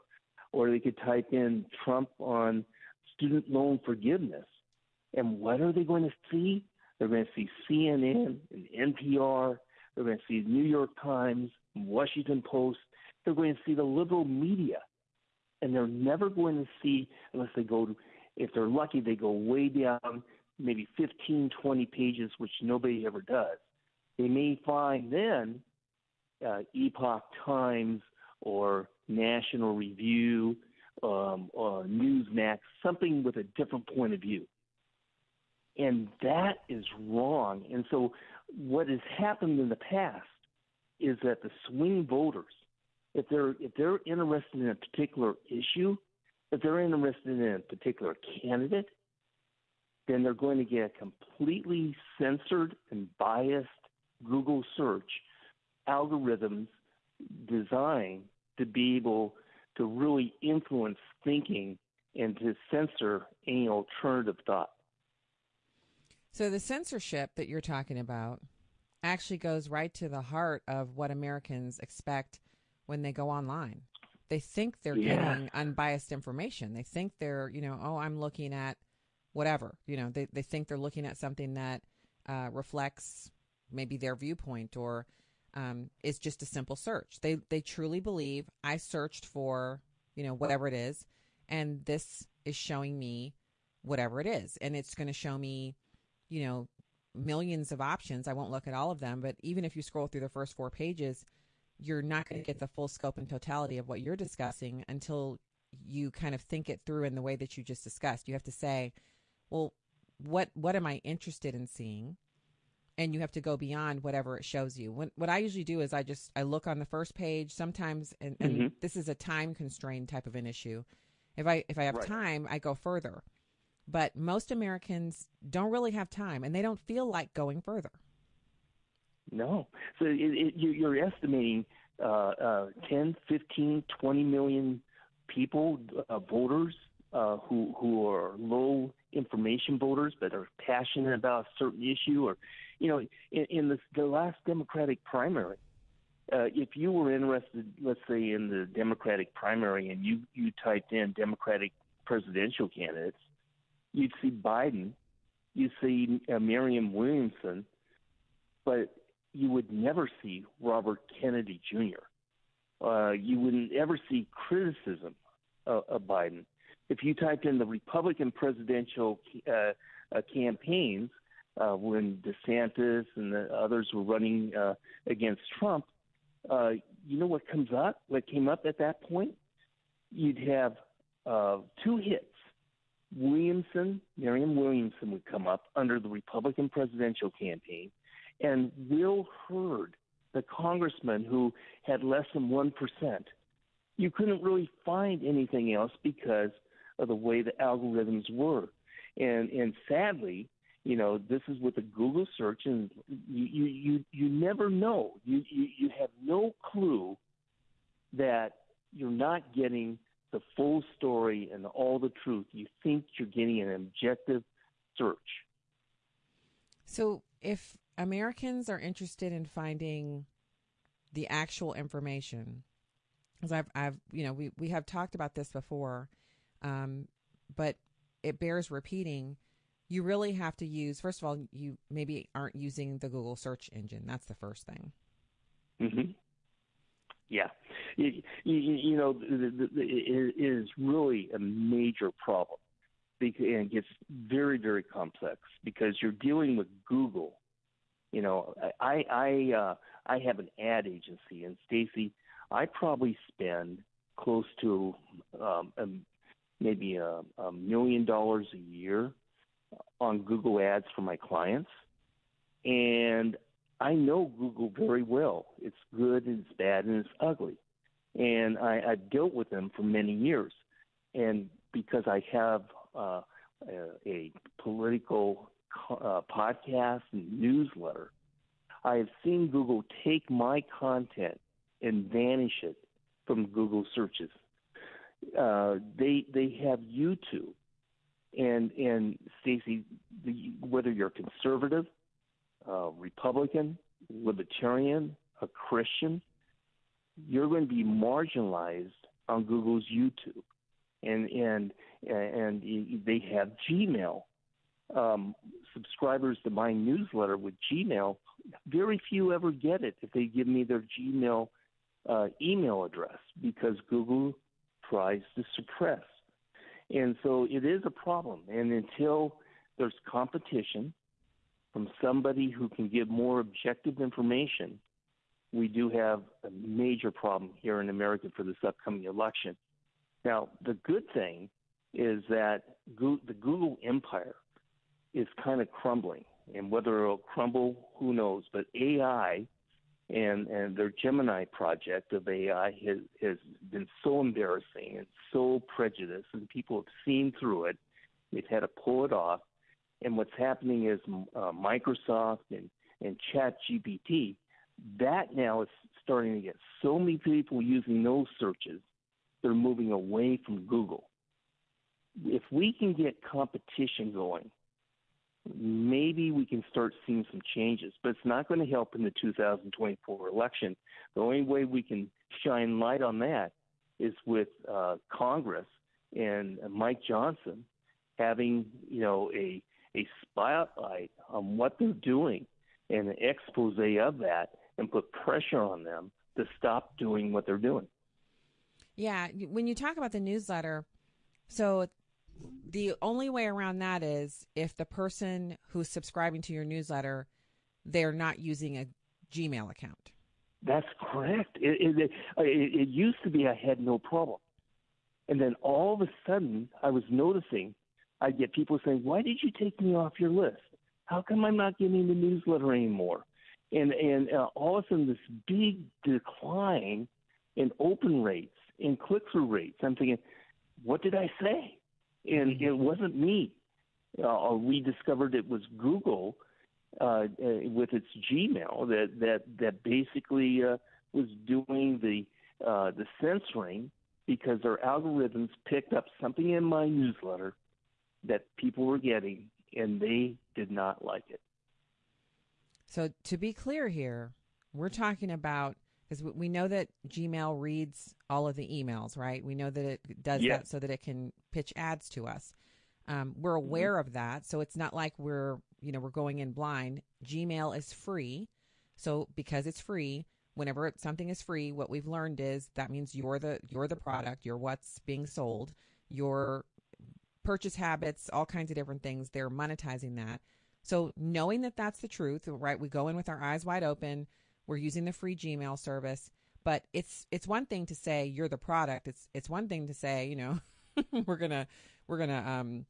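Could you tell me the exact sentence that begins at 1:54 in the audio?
When, what I usually do is I just I look on the first page sometimes, and, and mm-hmm.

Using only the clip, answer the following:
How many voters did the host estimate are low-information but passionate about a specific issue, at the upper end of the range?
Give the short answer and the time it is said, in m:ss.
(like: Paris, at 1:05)
20 million, at 2:14.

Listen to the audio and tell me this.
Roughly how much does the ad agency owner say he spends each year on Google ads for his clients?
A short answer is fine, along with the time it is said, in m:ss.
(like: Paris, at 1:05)
$1 million, at 4:17.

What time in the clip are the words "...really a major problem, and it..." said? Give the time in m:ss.
4:00.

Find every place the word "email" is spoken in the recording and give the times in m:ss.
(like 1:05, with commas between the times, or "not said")
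5:12, 7:28.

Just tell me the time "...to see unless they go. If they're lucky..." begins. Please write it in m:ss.
0:16.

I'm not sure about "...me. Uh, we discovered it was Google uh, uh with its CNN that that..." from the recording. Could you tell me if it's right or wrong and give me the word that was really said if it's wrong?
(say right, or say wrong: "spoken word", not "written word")
wrong: "Gmail", not "CNN".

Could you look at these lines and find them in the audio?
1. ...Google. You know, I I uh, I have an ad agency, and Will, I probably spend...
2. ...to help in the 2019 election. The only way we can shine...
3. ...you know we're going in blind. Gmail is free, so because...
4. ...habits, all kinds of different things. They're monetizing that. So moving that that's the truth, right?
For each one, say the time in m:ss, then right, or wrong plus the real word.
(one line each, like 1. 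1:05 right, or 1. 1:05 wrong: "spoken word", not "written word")
1. 4:06 wrong: "Stacy", not "Will"
2. 6:08 wrong: "2024", not "2019"
3. 7:35 right
4. 7:47 wrong: "knowing", not "moving".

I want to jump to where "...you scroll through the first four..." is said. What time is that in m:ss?
1:39.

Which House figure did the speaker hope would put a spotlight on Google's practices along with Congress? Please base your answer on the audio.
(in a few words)
Mike Johnson.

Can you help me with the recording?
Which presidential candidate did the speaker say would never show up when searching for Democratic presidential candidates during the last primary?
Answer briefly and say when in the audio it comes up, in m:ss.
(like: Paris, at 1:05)
Robert Kennedy Jr., at 2:40.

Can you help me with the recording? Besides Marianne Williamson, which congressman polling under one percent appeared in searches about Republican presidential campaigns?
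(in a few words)
Will Hurd.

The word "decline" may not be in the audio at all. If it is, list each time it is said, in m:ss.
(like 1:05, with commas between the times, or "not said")
6:56.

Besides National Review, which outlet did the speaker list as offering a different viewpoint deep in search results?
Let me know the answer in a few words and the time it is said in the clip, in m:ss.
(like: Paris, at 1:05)
Newsmax, at 0:31.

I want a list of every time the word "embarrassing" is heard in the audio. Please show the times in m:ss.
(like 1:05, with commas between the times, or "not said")
5:44.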